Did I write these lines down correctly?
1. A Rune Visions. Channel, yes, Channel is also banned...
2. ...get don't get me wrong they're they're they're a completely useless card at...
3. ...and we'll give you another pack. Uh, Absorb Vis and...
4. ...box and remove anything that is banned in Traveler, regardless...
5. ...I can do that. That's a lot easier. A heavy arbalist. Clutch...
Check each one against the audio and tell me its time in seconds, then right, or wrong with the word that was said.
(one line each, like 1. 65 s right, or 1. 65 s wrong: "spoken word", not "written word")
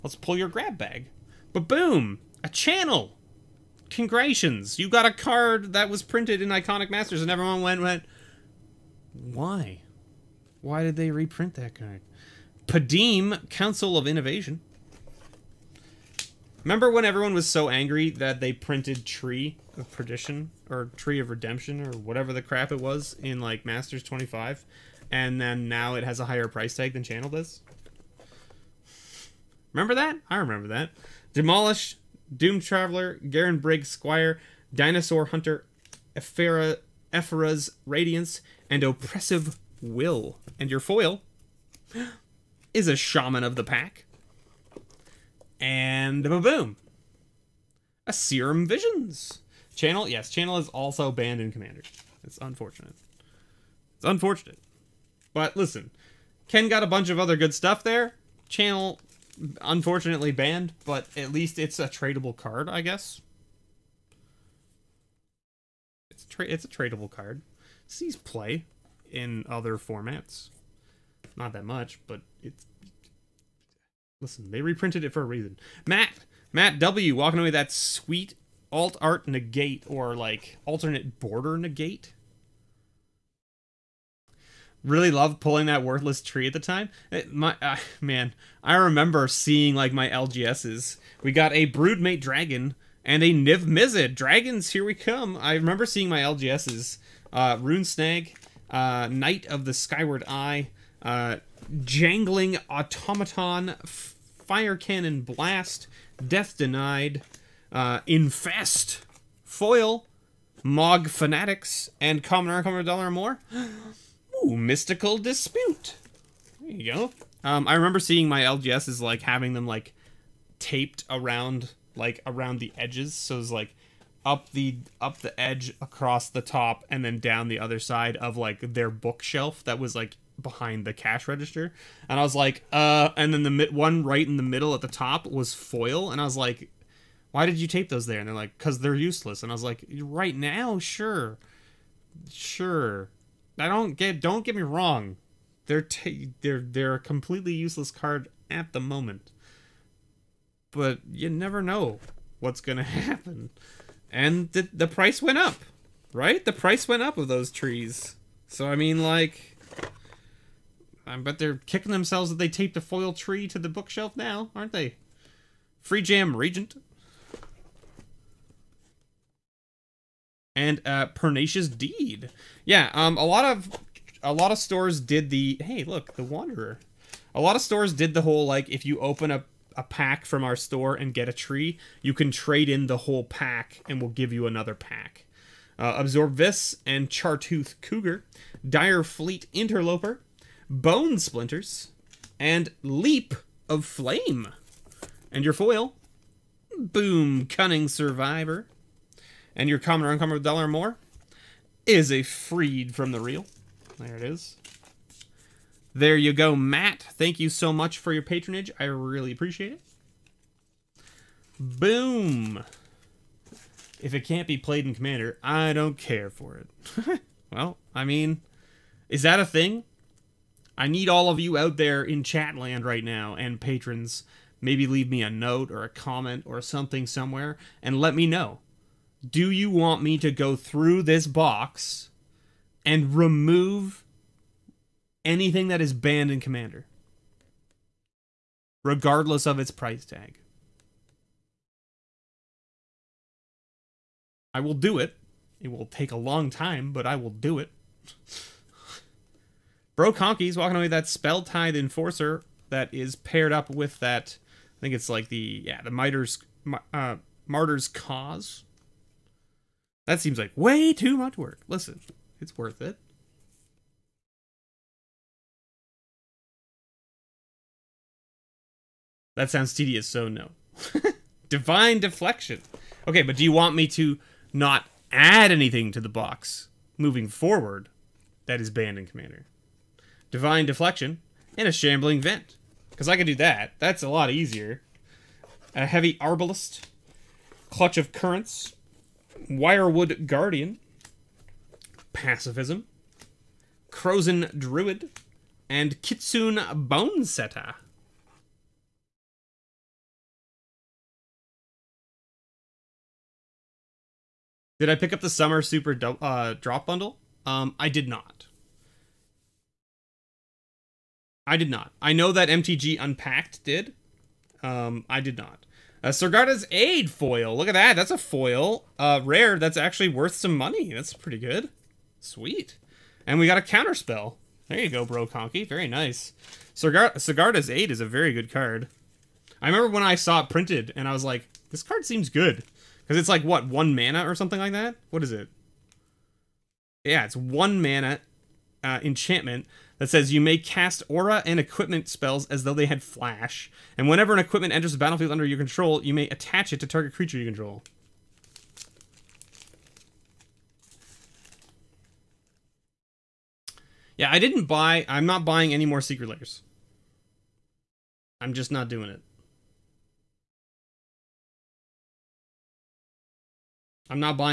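1. 48 s wrong: "Serum", not "Rune"
2. 143 s right
3. 183 s right
4. 231 s wrong: "Commander", not "Traveler"
5. 283 s right.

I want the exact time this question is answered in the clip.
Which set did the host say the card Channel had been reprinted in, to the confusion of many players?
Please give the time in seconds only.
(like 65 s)
6 s.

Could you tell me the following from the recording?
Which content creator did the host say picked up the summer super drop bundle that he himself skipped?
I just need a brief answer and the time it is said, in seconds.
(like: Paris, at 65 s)
MTG Unpacked, at 312 s.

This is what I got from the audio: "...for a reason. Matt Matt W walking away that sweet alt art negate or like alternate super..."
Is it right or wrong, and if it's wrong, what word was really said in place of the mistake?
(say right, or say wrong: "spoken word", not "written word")
wrong: "border", not "super".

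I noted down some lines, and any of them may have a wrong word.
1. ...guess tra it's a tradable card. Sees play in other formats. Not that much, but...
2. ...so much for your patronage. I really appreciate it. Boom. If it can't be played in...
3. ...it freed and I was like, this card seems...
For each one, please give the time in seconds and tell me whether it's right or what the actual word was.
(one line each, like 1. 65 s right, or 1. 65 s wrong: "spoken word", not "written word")
1. 62 s right
2. 207 s right
3. 330 s wrong: "printed", not "freed".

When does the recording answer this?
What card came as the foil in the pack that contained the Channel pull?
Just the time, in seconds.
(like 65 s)
42 s.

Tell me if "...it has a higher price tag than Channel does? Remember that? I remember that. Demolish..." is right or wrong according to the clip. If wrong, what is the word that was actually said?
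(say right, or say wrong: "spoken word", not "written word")
right.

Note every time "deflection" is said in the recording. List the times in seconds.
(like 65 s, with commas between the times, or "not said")
271 s, 280 s.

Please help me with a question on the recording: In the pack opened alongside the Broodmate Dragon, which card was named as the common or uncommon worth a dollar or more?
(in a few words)
Mystical Dispute.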